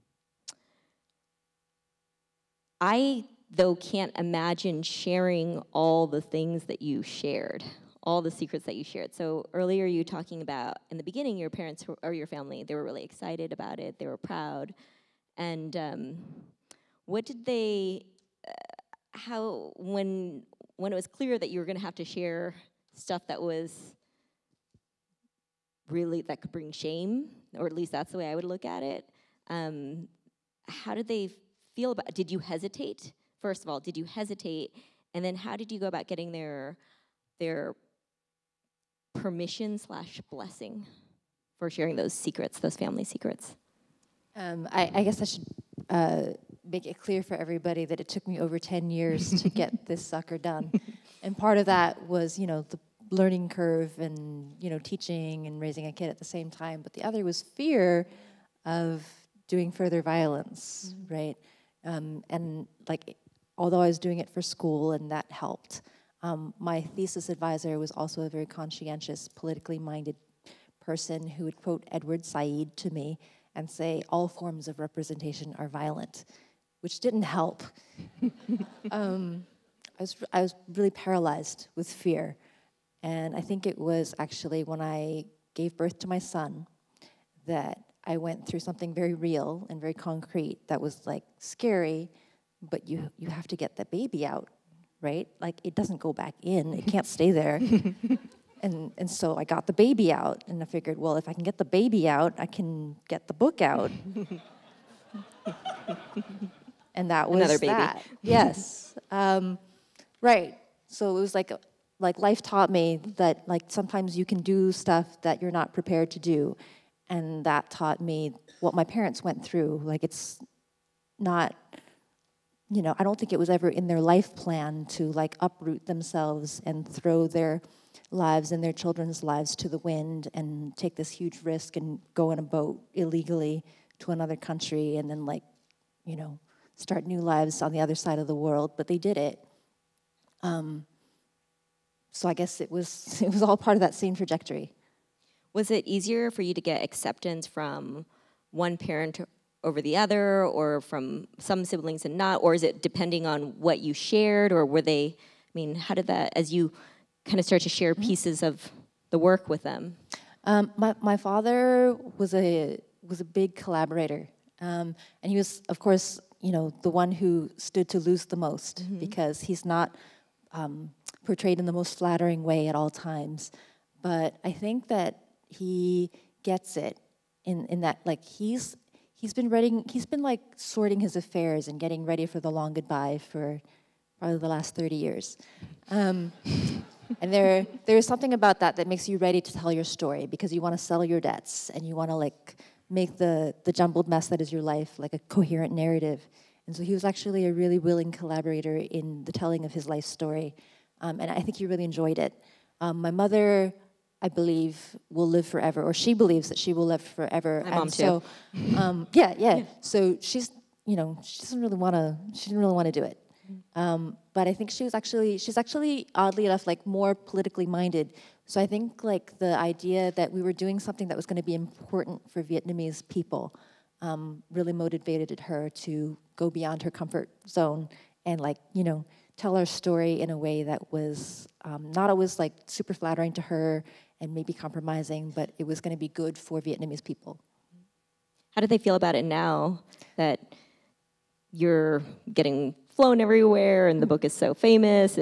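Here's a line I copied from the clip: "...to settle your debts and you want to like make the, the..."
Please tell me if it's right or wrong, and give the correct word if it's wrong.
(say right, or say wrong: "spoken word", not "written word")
right.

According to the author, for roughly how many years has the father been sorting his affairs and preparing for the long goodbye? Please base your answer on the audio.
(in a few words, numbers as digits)
30 years.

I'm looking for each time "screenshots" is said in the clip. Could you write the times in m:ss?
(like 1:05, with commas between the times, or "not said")
not said.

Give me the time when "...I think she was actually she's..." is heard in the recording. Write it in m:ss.
3:34.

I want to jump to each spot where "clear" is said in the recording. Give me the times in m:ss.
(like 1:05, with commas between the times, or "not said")
0:21, 0:46.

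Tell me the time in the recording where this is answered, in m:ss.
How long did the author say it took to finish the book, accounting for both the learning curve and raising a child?
0:48.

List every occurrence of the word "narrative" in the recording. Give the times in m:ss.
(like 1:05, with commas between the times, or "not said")
3:15.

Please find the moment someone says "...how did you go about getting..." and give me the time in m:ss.
0:35.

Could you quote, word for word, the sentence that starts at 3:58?
How do they feel about it now that you're getting flown everywhere and the mm.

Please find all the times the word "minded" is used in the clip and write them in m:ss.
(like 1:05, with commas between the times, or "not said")
1:09, 3:37.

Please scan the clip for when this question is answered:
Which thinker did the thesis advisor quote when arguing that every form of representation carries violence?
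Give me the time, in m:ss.
1:11.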